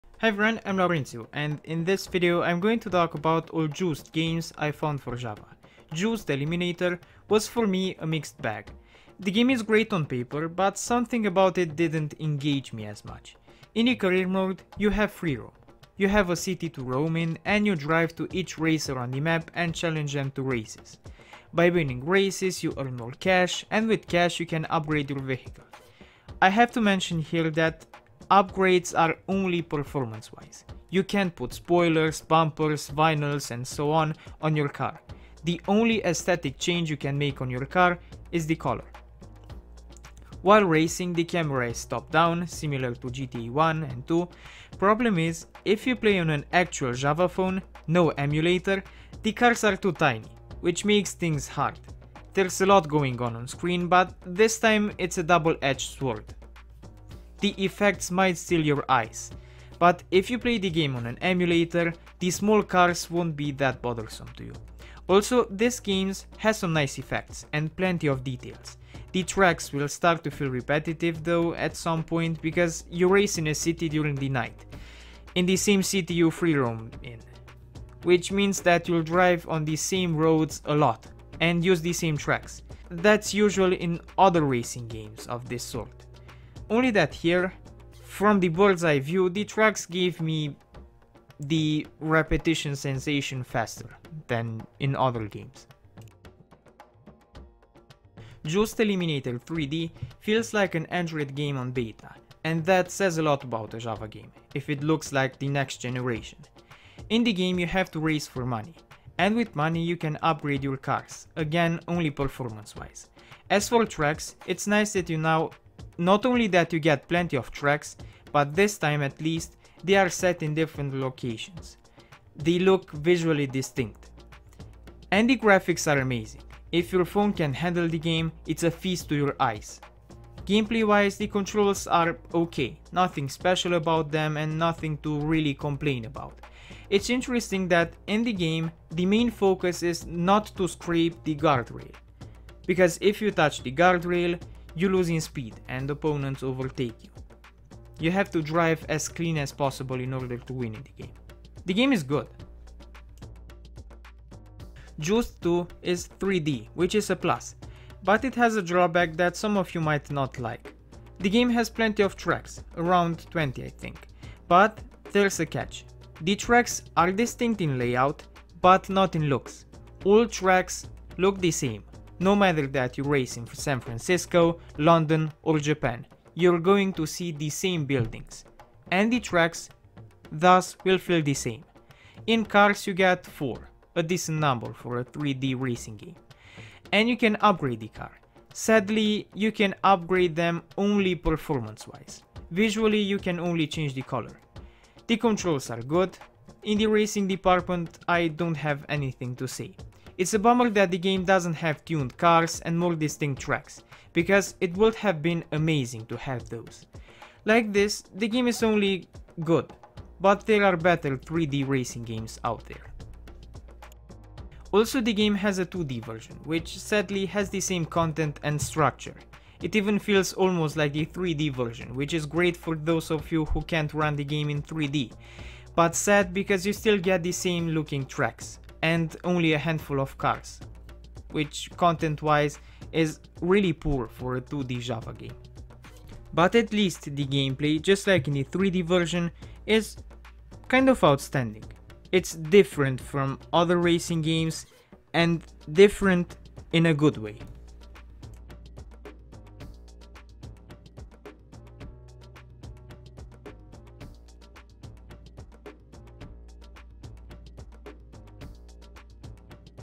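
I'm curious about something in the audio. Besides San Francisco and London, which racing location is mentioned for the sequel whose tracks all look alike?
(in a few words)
Japan.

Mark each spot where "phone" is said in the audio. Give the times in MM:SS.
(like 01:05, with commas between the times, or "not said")
00:47, 02:07.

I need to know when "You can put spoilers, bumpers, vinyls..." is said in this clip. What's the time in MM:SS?
00:30.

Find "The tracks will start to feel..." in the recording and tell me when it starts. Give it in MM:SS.
01:09.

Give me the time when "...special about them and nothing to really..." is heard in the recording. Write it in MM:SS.
02:13.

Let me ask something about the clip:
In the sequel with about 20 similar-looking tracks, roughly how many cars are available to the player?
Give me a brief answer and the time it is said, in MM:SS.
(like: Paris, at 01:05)
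4, at 03:03.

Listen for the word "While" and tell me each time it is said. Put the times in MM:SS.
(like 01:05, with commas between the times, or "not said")
00:40.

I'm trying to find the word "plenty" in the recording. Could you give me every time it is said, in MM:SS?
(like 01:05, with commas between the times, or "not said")
01:07, 01:57, 02:41.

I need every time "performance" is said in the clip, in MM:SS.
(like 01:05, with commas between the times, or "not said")
00:29, 01:52, 03:11.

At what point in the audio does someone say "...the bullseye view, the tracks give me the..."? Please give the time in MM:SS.
01:28.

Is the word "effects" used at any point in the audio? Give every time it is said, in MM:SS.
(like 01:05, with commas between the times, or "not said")
00:57, 01:06.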